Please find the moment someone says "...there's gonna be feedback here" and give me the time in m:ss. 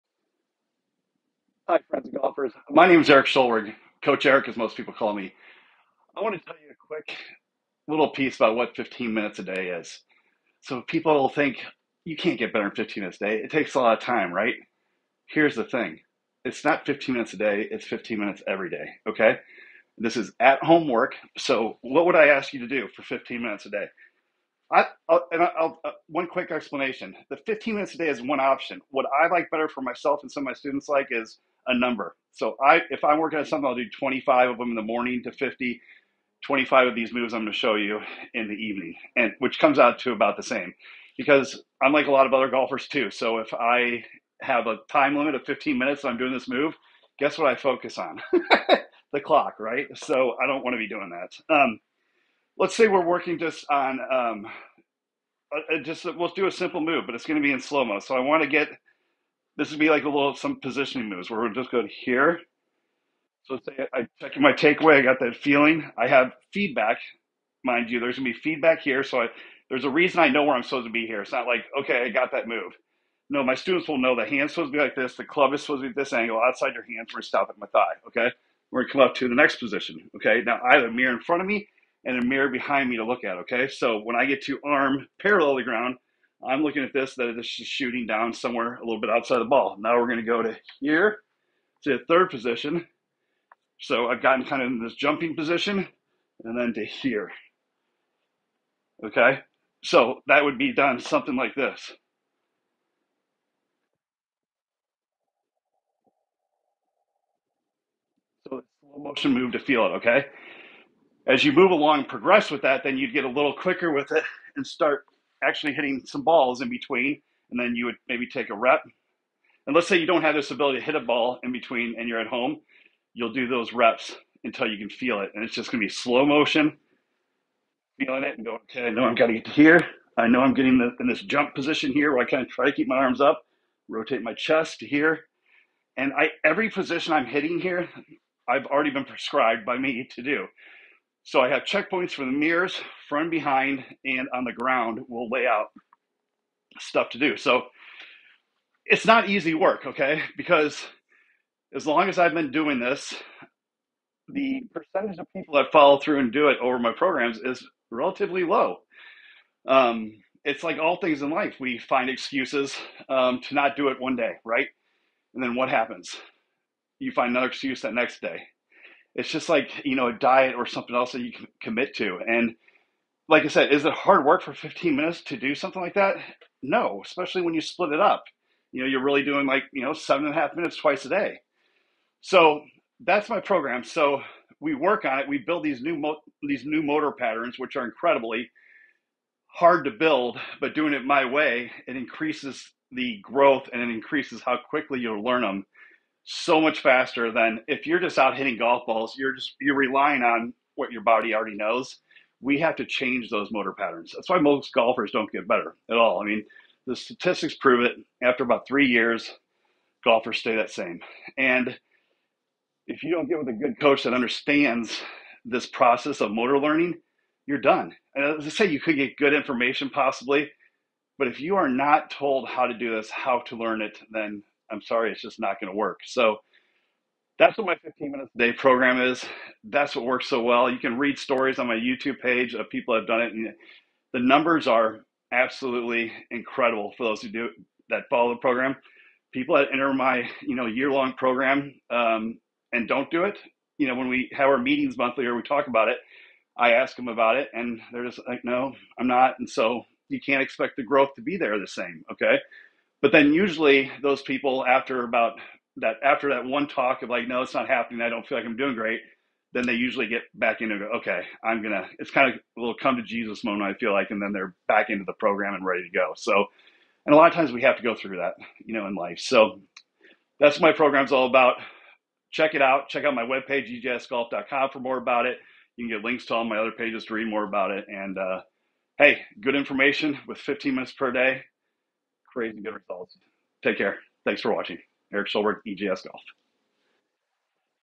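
1:07.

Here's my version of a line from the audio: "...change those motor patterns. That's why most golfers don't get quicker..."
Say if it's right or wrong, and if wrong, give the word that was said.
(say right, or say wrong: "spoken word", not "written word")
wrong: "better", not "quicker".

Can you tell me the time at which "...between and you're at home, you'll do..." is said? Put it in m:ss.
2:01.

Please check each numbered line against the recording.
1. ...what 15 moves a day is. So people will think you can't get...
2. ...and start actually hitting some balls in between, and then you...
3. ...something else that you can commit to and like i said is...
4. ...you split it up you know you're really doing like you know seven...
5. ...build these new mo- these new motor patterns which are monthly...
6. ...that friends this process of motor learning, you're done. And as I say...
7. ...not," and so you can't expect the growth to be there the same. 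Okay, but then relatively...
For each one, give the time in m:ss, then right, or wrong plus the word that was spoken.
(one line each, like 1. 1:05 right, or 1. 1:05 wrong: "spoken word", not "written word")
1. 0:08 wrong: "minutes", not "moves"
2. 1:54 right
3. 2:50 right
4. 2:57 right
5. 3:05 wrong: "incredibly", not "monthly"
6. 3:34 wrong: "understands", not "friends"
7. 4:09 wrong: "usually", not "relatively".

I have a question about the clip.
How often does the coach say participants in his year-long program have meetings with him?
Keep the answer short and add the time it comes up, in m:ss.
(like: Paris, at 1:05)
monthly, at 4:04.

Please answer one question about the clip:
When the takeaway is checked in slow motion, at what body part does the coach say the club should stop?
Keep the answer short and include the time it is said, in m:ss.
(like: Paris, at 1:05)
thigh, at 1:17.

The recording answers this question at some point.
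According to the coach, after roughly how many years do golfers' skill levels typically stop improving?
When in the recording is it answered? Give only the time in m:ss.
3:28.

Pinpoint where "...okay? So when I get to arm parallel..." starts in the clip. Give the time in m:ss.
1:23.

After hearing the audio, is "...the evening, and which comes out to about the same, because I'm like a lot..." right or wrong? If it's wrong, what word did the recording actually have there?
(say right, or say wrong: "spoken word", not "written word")
right.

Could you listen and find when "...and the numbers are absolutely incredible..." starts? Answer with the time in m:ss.
3:53.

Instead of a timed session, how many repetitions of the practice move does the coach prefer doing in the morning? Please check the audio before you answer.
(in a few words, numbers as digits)
25.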